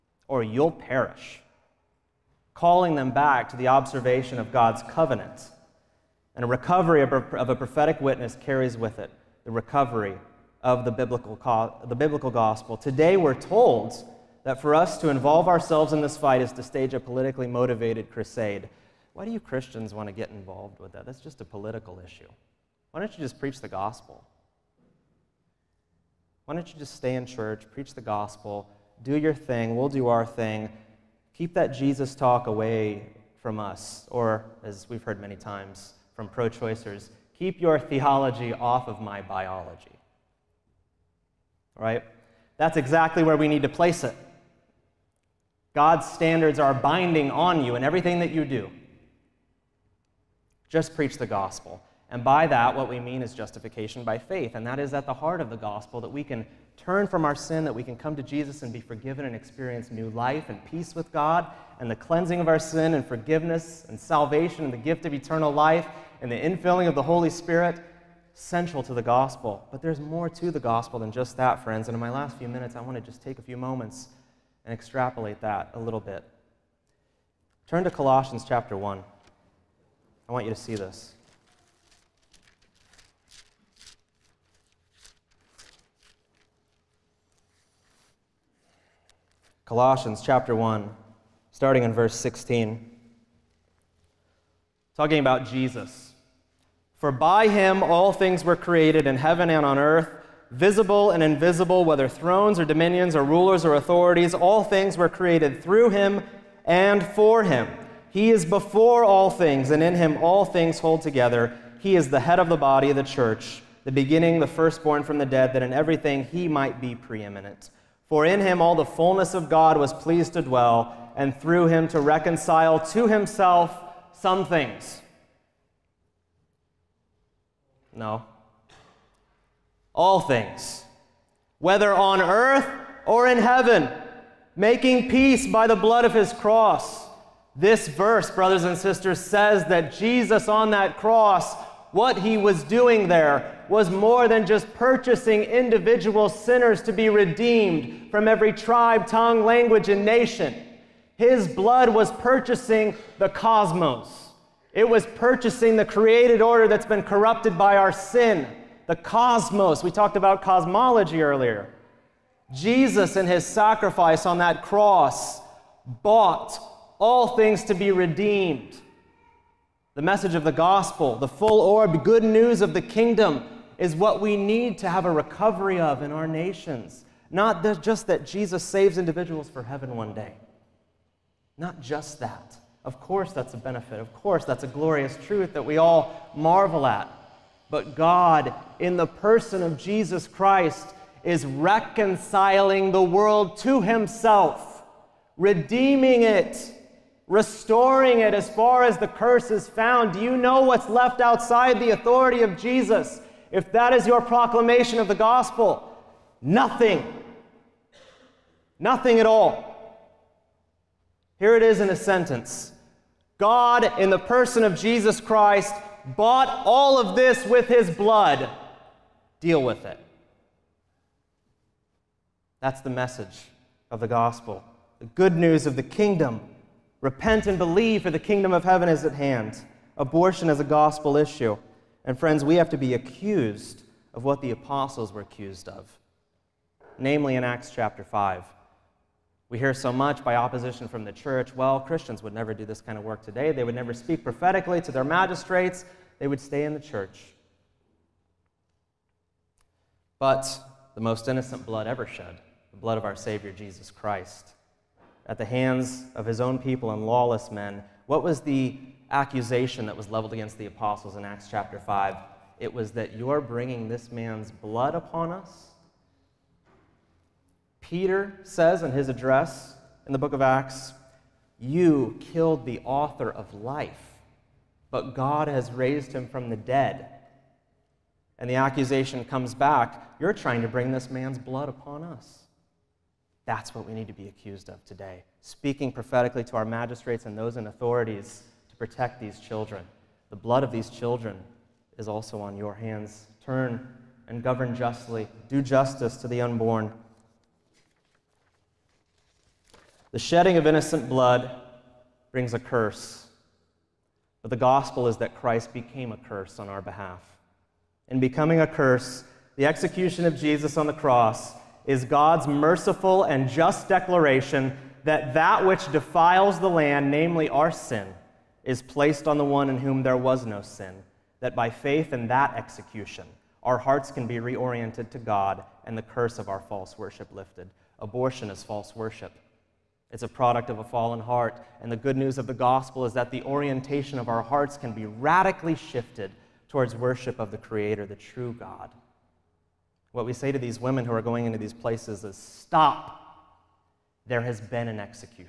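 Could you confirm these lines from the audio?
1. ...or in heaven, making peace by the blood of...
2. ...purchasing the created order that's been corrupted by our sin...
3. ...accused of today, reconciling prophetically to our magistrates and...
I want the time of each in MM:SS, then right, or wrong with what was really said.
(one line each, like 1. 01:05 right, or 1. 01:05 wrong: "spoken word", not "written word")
1. 02:13 right
2. 02:35 right
3. 04:44 wrong: "speaking", not "reconciling".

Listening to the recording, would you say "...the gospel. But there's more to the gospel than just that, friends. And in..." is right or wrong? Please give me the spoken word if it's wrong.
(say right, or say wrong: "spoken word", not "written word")
right.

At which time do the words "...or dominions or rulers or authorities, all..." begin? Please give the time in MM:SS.
01:42.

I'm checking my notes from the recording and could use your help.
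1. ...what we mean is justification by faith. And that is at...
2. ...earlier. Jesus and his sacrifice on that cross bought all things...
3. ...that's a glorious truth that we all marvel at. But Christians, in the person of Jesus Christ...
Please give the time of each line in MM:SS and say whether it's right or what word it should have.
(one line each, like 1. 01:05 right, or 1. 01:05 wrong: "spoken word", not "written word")
1. 00:52 right
2. 02:41 right
3. 03:04 wrong: "God", not "Christians".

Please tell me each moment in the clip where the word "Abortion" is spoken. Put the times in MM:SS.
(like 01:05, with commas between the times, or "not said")
03:49, 05:28.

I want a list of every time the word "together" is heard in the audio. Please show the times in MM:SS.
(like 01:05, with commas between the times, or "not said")
01:51.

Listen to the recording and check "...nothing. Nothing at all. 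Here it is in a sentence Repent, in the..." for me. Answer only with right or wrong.
wrong.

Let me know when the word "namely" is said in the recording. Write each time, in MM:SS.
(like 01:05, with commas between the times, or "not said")
03:56, 05:17.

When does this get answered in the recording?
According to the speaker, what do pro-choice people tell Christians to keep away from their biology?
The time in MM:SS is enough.
00:37.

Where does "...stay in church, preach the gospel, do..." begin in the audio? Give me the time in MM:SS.
00:26.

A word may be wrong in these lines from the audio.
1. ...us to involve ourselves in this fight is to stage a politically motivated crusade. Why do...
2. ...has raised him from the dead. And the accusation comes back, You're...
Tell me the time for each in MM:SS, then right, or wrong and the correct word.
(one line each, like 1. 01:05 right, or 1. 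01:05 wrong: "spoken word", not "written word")
1. 00:14 right
2. 04:35 right.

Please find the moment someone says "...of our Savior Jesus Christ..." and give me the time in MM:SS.
04:12.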